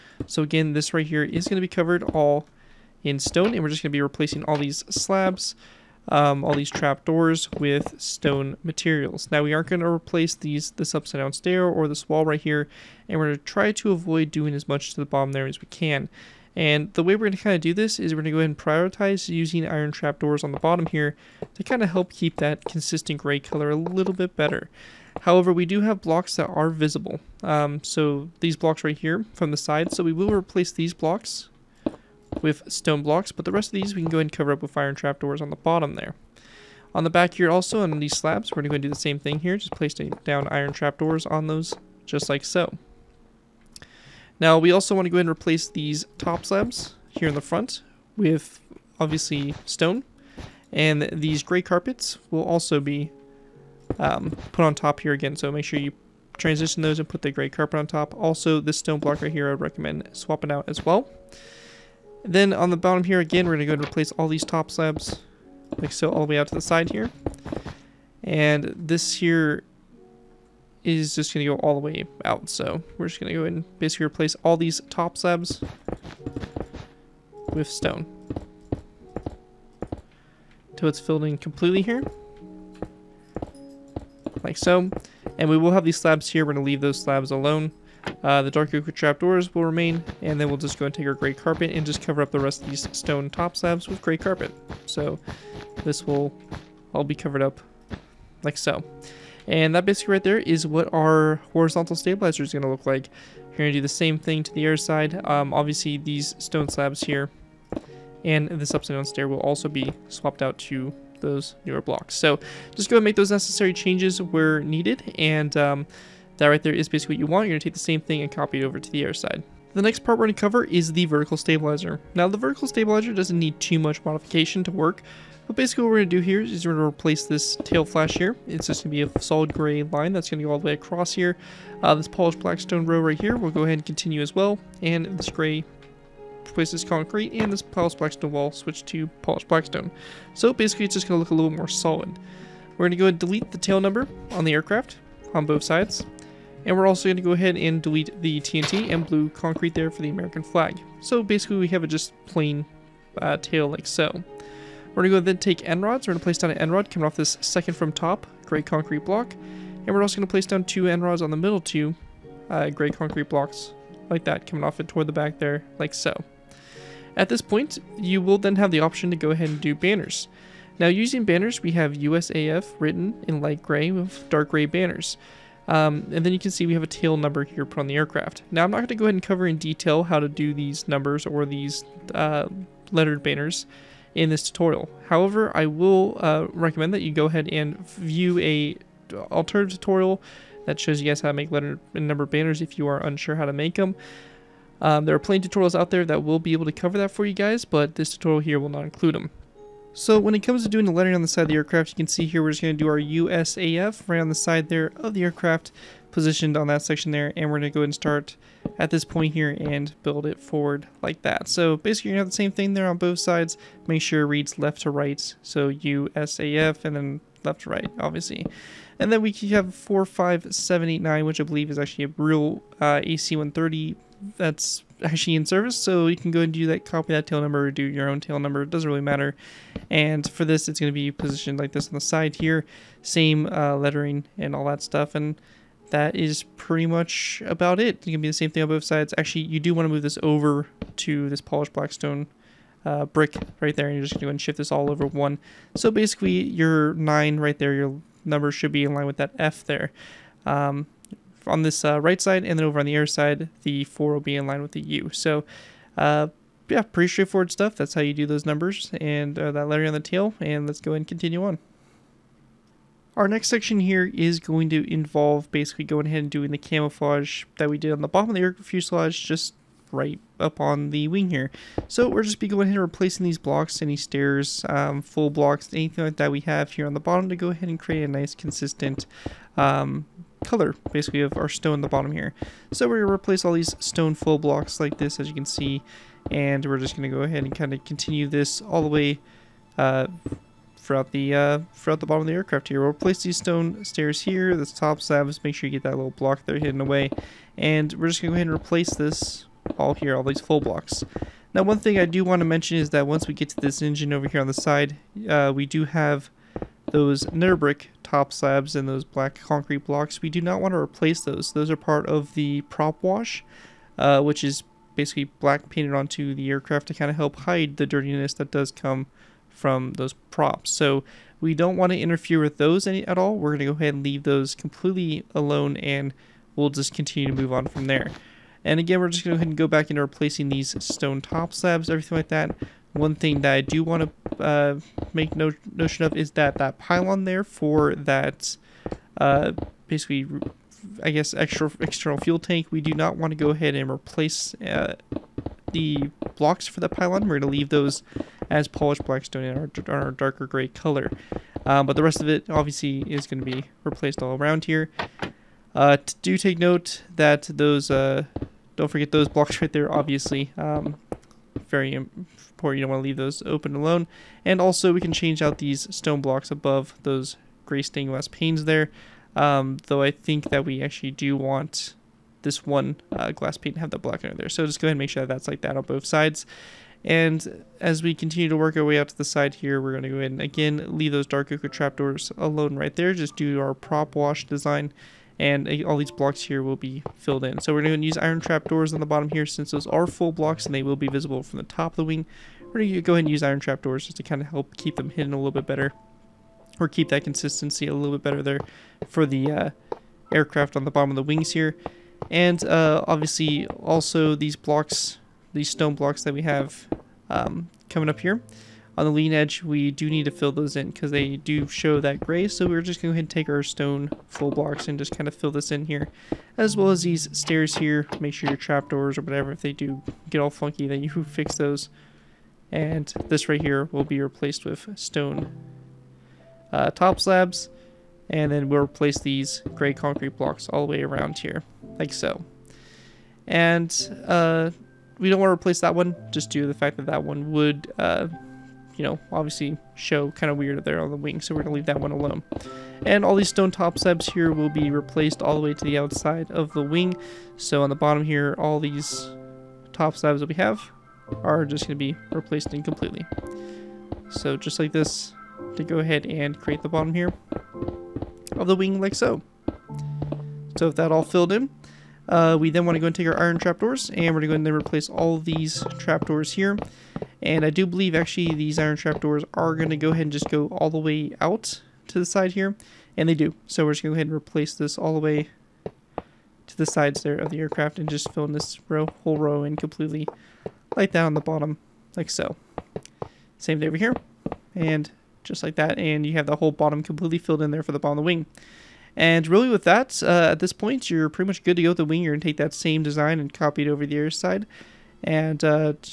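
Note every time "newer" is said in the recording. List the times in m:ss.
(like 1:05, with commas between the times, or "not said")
1:51.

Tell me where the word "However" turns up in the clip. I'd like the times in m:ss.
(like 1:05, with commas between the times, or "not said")
0:25, 3:05.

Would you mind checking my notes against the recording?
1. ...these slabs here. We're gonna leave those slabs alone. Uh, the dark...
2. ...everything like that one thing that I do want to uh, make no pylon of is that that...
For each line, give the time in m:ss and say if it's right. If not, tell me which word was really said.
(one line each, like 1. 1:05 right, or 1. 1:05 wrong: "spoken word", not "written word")
1. 1:25 right
2. 5:31 wrong: "notion", not "pylon".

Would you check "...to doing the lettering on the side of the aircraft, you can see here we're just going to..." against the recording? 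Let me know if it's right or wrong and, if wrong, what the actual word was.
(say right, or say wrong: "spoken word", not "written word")
right.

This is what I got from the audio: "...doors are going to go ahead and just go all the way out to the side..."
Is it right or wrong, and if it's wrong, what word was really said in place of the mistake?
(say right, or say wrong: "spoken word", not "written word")
wrong: "trapdoors", not "doors".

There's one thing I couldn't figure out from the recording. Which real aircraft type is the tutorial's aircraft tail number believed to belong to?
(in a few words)
AC-130.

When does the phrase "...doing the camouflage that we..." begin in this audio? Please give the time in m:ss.
4:26.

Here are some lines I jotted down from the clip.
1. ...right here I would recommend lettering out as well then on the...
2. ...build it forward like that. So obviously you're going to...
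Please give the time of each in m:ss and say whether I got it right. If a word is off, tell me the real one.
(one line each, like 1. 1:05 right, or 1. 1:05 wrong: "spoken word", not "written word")
1. 0:59 wrong: "swapping", not "lettering"
2. 3:30 wrong: "basically", not "obviously".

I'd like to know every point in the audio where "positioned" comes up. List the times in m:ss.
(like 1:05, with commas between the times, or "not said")
3:26, 3:51.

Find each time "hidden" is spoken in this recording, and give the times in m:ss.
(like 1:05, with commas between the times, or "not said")
4:56, 6:35.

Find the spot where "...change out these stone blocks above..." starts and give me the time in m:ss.
6:05.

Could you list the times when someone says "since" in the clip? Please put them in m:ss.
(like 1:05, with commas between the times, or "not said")
6:29.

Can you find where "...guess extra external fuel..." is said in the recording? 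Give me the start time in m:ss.
5:41.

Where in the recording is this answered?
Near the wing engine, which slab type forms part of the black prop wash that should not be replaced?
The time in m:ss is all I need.
5:07.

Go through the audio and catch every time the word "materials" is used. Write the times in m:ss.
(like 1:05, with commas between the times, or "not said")
0:08.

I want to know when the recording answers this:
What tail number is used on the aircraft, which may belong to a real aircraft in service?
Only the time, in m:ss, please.
3:39.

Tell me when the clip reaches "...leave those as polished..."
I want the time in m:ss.
5:47.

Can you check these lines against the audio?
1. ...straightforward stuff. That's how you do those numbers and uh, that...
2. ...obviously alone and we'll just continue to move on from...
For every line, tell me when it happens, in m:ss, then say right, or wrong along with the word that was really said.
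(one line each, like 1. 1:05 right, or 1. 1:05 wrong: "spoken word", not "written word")
1. 4:17 right
2. 5:24 wrong: "completely", not "obviously".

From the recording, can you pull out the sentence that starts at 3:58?
It can be the same thing on both sides.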